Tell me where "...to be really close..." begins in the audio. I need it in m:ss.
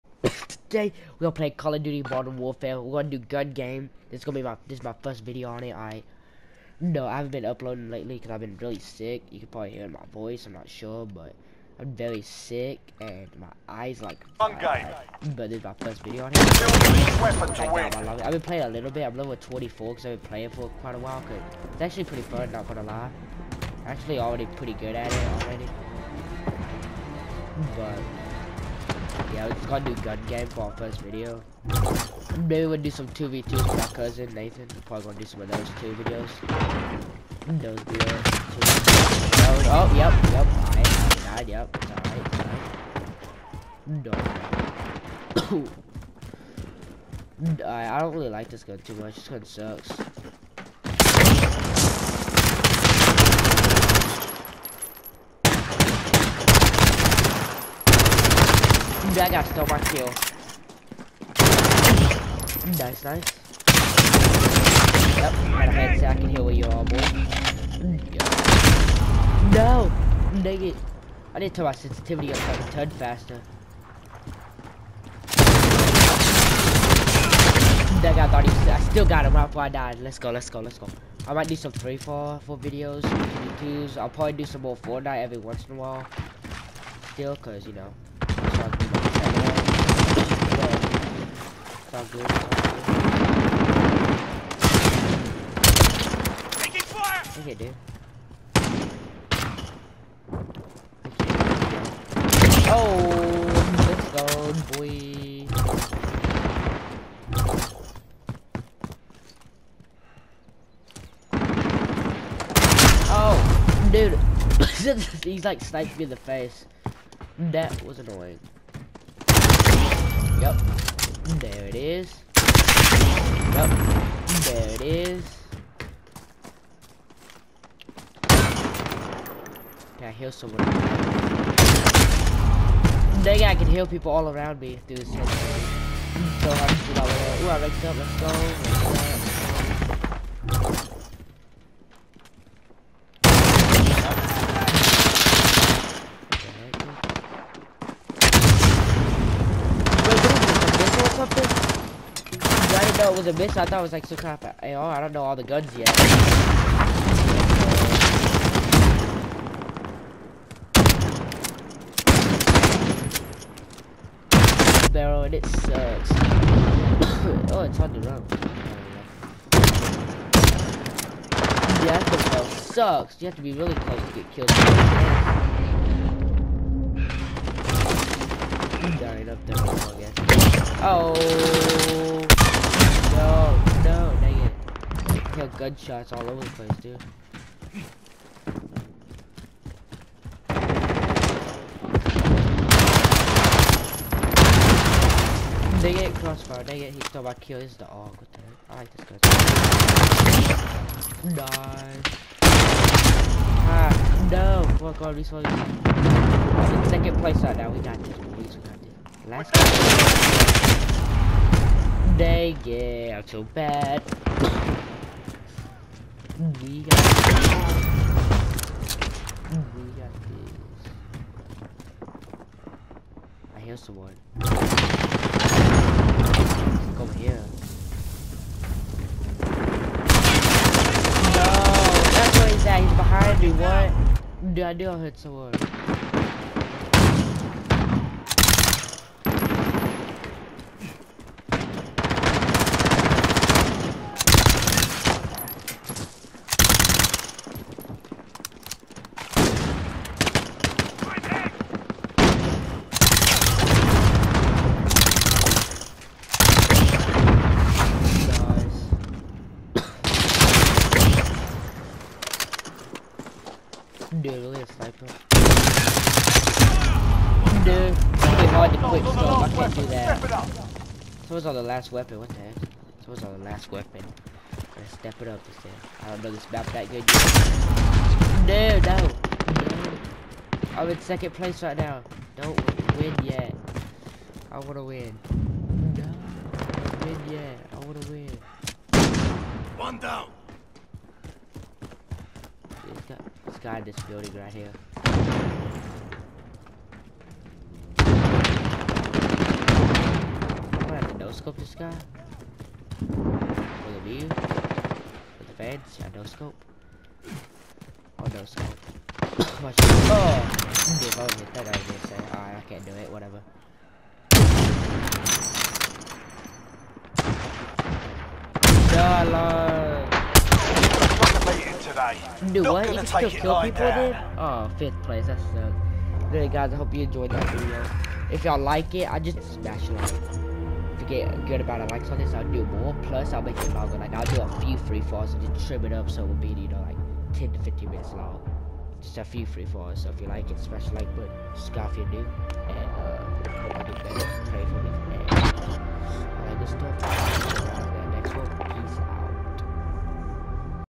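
2:53.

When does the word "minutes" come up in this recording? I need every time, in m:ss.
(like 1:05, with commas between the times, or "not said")
5:37.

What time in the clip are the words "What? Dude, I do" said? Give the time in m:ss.
3:53.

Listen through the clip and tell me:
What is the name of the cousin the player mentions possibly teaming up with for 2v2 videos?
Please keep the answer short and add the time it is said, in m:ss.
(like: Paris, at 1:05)
Nathan, at 0:34.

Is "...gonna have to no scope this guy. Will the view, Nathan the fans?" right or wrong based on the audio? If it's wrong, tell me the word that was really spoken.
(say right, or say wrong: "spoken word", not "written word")
wrong: "With", not "Nathan".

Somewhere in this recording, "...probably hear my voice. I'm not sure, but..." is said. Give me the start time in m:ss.
0:09.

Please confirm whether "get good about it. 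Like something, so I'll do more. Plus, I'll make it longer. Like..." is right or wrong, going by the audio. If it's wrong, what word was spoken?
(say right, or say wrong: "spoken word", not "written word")
right.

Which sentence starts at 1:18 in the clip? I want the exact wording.
That guy thought he was, I still got him right before I died.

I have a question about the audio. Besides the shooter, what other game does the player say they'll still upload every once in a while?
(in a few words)
Fortnite.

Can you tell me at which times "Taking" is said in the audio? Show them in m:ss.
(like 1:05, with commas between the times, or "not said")
1:36.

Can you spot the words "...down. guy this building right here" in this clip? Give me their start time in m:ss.
4:49.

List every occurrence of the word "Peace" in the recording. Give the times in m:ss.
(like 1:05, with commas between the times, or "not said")
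5:48.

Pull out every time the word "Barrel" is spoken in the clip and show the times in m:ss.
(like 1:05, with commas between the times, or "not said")
2:44.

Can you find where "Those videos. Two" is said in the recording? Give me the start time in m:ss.
0:37.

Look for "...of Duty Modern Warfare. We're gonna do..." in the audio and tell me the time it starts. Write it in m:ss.
0:01.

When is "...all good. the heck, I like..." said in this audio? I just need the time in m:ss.
3:17.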